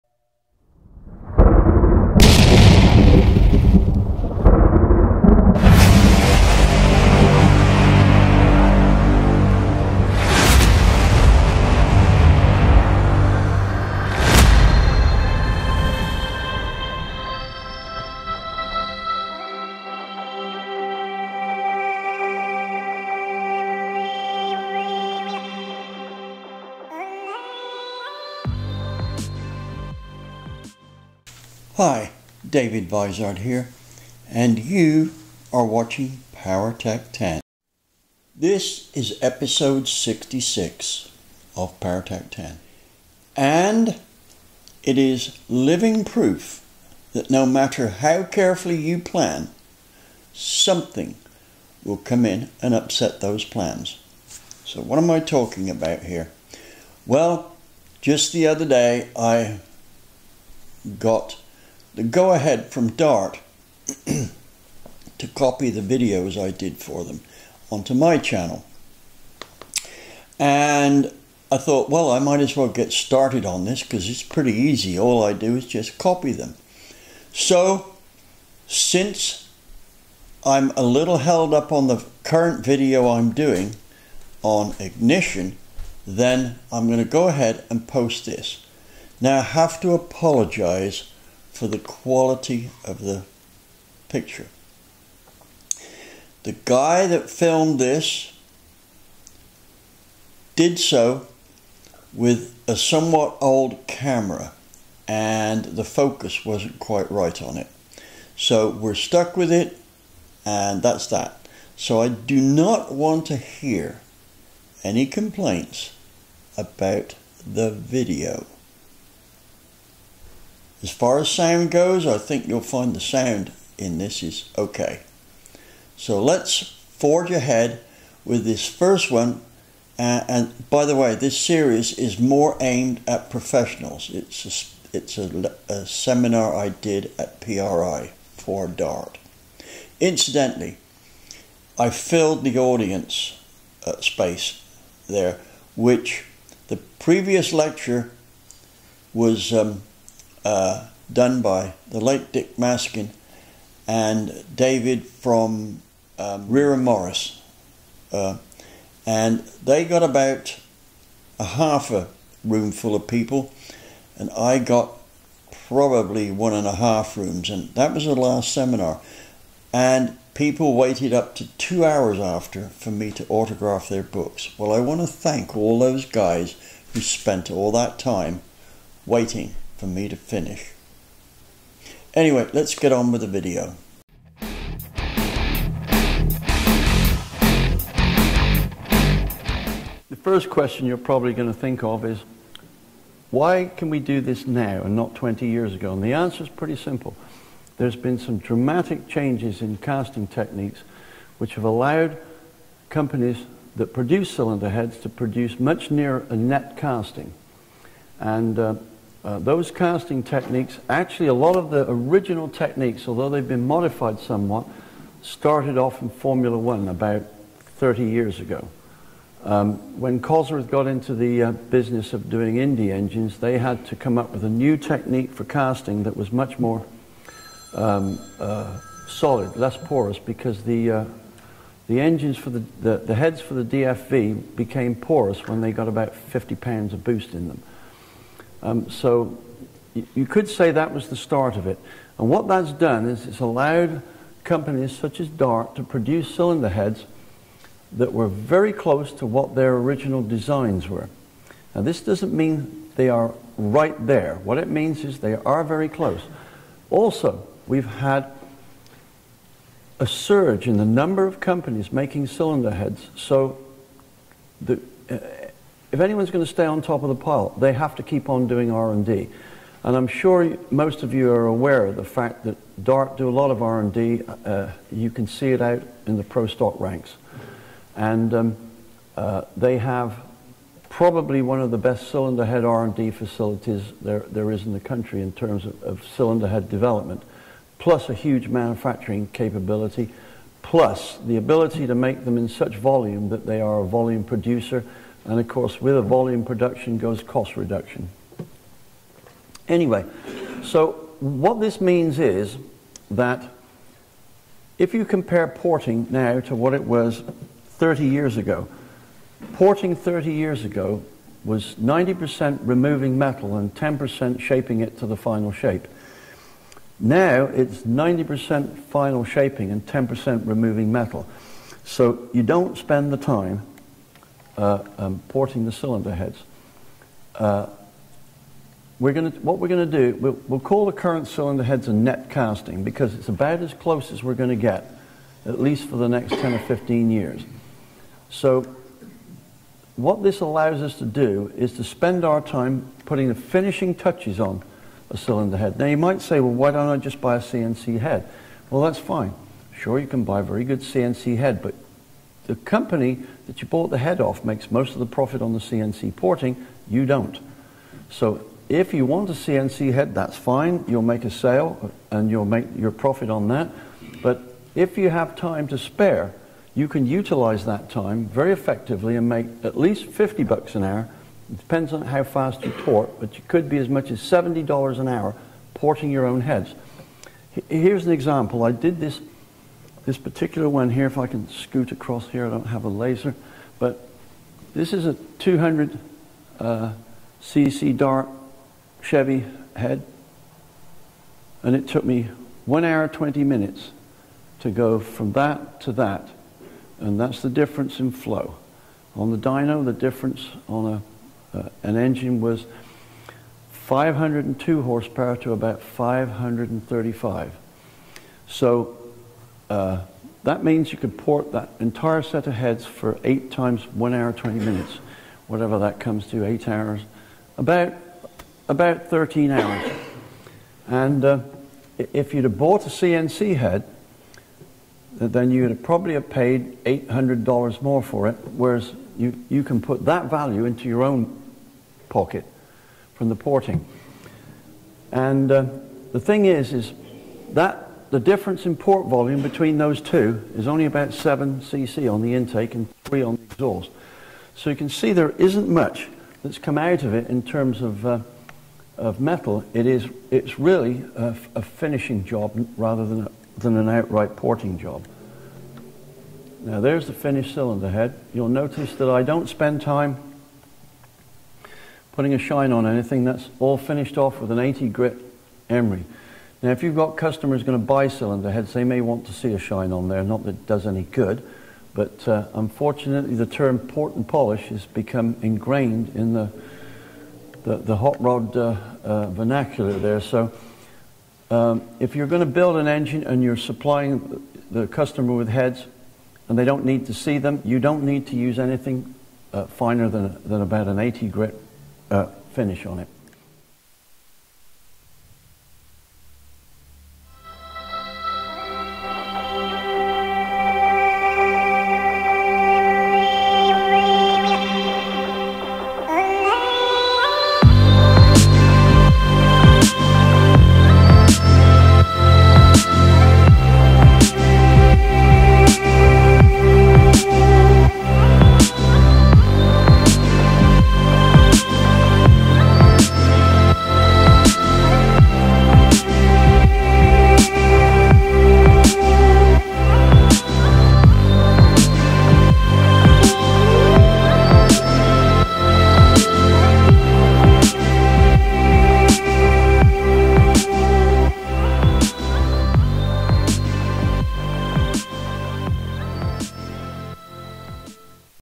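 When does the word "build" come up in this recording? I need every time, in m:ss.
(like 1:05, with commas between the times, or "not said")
8:02.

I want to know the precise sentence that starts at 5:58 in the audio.
So if you want a CNC head, that's fine.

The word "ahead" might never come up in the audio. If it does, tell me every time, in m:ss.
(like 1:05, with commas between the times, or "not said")
1:02, 1:27, 2:07.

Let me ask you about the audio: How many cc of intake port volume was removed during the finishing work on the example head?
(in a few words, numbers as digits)
7 cc.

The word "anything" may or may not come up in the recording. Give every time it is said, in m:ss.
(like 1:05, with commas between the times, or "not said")
7:42, 8:08.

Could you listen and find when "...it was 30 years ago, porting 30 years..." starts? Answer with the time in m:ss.
5:06.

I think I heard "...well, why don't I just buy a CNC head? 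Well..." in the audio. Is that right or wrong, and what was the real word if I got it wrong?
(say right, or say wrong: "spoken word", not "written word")
right.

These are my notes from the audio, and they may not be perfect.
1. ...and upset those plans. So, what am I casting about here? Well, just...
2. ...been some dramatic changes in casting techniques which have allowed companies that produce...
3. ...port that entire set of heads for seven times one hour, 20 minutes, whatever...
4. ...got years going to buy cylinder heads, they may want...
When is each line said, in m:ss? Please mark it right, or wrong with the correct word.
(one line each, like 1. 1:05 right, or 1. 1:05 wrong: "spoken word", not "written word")
1. 0:52 wrong: "talking", not "casting"
2. 3:17 right
3. 6:51 wrong: "eight", not "seven"
4. 7:46 wrong: "customers", not "years".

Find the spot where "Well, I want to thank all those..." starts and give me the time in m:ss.
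2:54.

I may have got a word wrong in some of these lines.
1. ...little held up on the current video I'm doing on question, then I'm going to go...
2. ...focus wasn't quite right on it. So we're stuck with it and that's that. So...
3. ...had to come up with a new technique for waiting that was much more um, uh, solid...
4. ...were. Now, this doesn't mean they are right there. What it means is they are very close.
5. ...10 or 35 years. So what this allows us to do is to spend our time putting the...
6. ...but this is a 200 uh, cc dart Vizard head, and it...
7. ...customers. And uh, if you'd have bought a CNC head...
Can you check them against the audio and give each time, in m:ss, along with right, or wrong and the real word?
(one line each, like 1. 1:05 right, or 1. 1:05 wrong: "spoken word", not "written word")
1. 1:20 wrong: "ignition", not "question"
2. 1:45 right
3. 3:43 wrong: "casting", not "waiting"
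4. 4:10 right
5. 5:36 wrong: "15", not "35"
6. 6:23 wrong: "Chevy", not "Vizard"
7. 6:59 wrong: "hours", not "customers".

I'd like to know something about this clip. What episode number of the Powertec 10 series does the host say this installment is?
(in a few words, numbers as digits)
66.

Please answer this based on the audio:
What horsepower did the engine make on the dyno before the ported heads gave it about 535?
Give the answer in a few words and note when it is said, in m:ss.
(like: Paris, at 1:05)
502, at 6:43.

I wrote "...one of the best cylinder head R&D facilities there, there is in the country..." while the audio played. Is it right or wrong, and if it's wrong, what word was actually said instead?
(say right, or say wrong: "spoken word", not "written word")
right.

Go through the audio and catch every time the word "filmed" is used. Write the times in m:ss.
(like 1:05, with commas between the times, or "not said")
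1:37.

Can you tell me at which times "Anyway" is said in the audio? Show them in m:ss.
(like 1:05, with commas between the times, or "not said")
3:02, 4:59.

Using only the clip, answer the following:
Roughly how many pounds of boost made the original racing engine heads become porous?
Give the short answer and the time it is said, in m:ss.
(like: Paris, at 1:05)
50 pounds, at 3:56.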